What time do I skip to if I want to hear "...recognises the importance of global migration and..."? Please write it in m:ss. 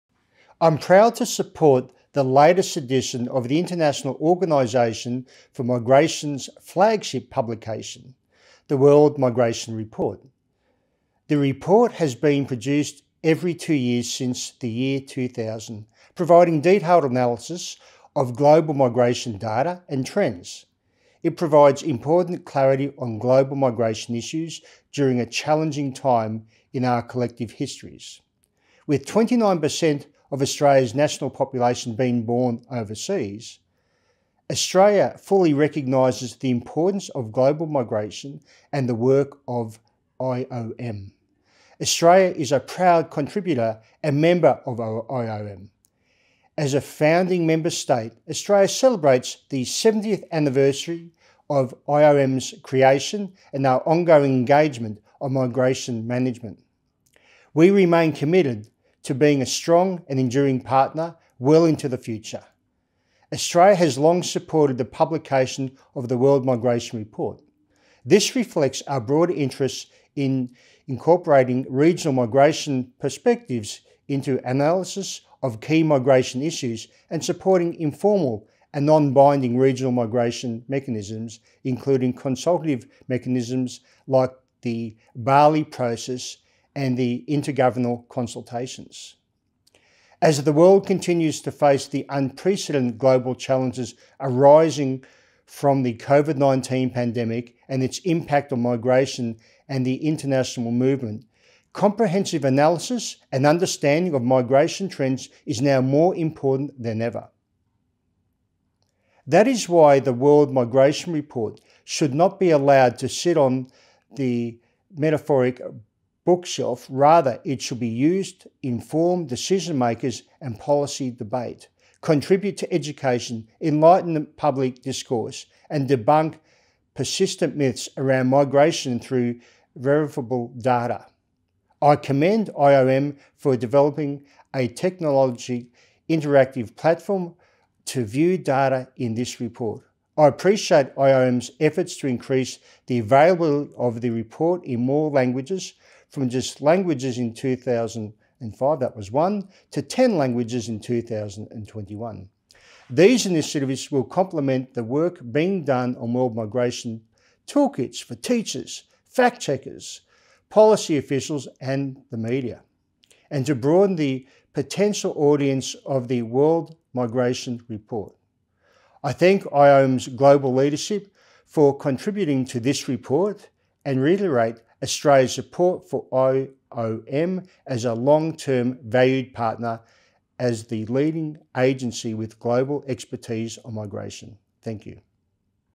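0:35.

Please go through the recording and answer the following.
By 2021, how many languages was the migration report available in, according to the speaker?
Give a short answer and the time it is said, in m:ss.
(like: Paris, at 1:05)
10, at 2:29.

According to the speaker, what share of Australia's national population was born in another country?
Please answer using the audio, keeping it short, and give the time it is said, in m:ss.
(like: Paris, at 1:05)
29%, at 0:29.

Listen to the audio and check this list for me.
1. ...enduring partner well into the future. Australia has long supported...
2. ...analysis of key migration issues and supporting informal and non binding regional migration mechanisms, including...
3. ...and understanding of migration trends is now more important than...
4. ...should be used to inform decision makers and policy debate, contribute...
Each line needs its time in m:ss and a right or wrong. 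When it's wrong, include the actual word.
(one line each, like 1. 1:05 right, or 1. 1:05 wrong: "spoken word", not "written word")
1. 1:00 right
2. 1:14 right
3. 1:43 right
4. 1:57 right.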